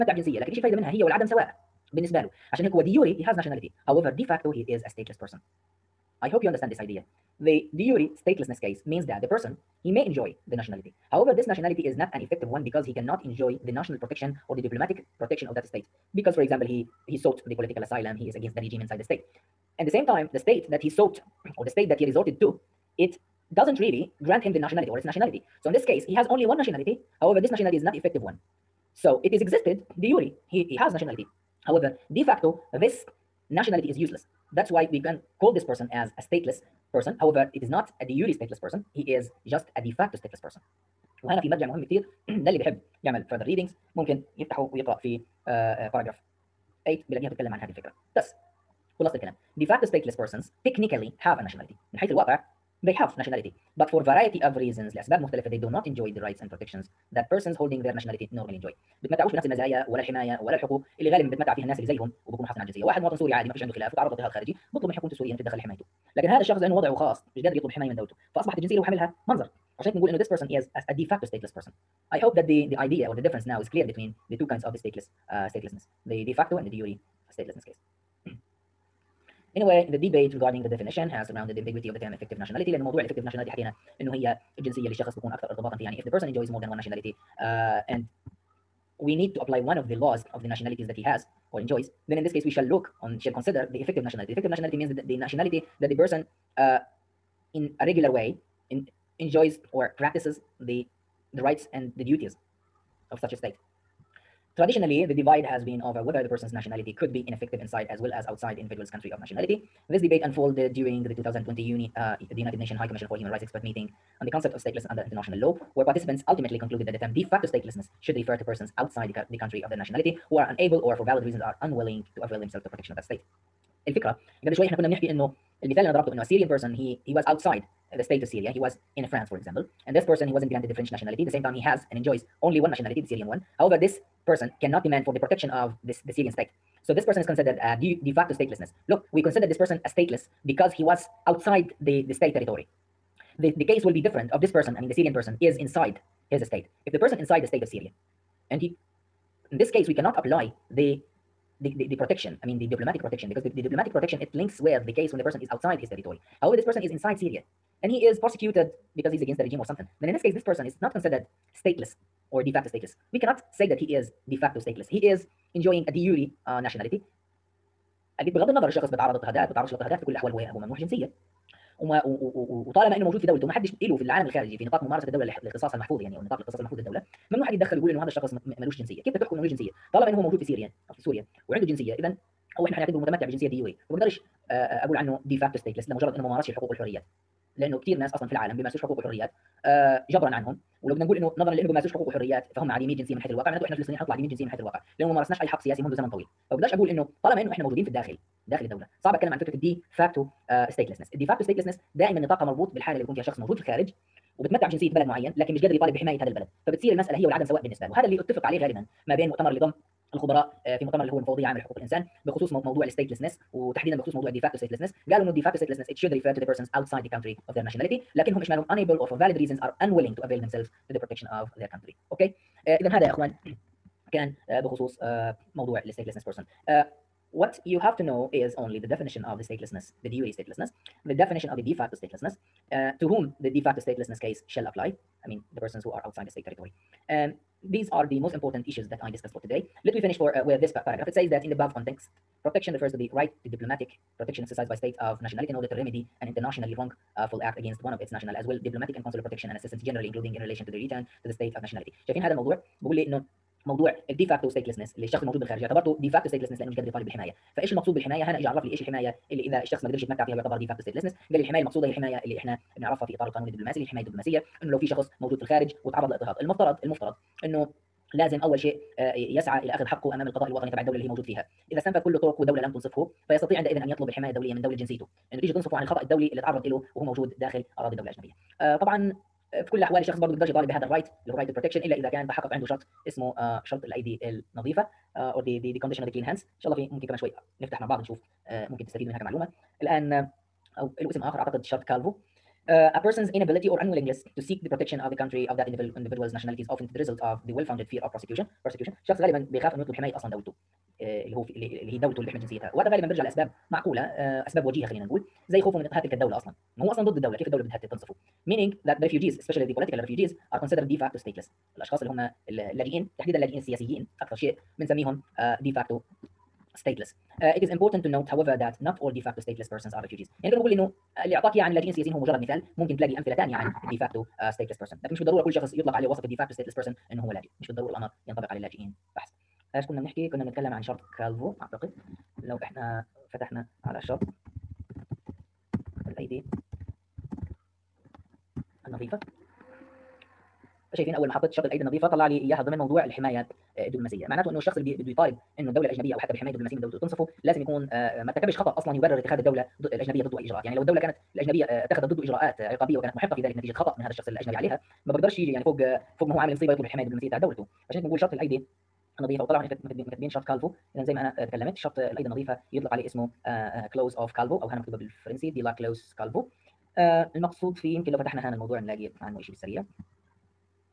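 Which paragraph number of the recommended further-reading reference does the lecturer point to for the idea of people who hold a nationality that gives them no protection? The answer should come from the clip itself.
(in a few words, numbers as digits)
8.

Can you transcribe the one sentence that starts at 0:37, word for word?
However, it is not a de jure stateless person.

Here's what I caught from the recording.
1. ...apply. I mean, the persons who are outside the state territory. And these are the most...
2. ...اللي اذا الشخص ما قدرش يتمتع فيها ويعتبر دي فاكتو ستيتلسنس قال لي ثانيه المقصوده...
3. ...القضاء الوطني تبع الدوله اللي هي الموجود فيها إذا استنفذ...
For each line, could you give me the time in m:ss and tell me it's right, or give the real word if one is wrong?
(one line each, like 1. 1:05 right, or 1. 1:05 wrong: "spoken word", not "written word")
1. 3:54 right
2. 4:19 wrong: "الحمايه", not "ثانيه"
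3. 4:30 wrong: "موجود", not "الموجود".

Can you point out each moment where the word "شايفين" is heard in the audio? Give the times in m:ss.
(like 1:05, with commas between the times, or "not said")
4:12, 5:40.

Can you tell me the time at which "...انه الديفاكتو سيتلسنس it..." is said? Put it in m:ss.
3:35.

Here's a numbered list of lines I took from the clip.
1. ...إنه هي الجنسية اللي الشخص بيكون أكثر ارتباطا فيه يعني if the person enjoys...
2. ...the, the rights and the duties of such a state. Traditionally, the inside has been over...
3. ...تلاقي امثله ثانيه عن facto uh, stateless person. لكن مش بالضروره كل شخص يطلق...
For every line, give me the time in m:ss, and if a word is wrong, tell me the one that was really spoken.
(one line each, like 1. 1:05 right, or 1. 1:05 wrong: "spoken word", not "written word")
1. 1:24 right
2. 1:40 wrong: "divide", not "inside"
3. 5:22 right.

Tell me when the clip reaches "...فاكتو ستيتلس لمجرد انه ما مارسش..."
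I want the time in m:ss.
3:05.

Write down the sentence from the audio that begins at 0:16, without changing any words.
Because, for example, he, he sought the political asylum, he is against the regime inside the state.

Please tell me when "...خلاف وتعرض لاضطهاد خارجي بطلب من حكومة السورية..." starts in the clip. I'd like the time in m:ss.
1:03.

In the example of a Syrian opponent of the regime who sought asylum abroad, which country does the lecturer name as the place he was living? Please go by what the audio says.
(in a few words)
France.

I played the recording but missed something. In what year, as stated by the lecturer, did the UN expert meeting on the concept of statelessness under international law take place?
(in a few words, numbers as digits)
2020.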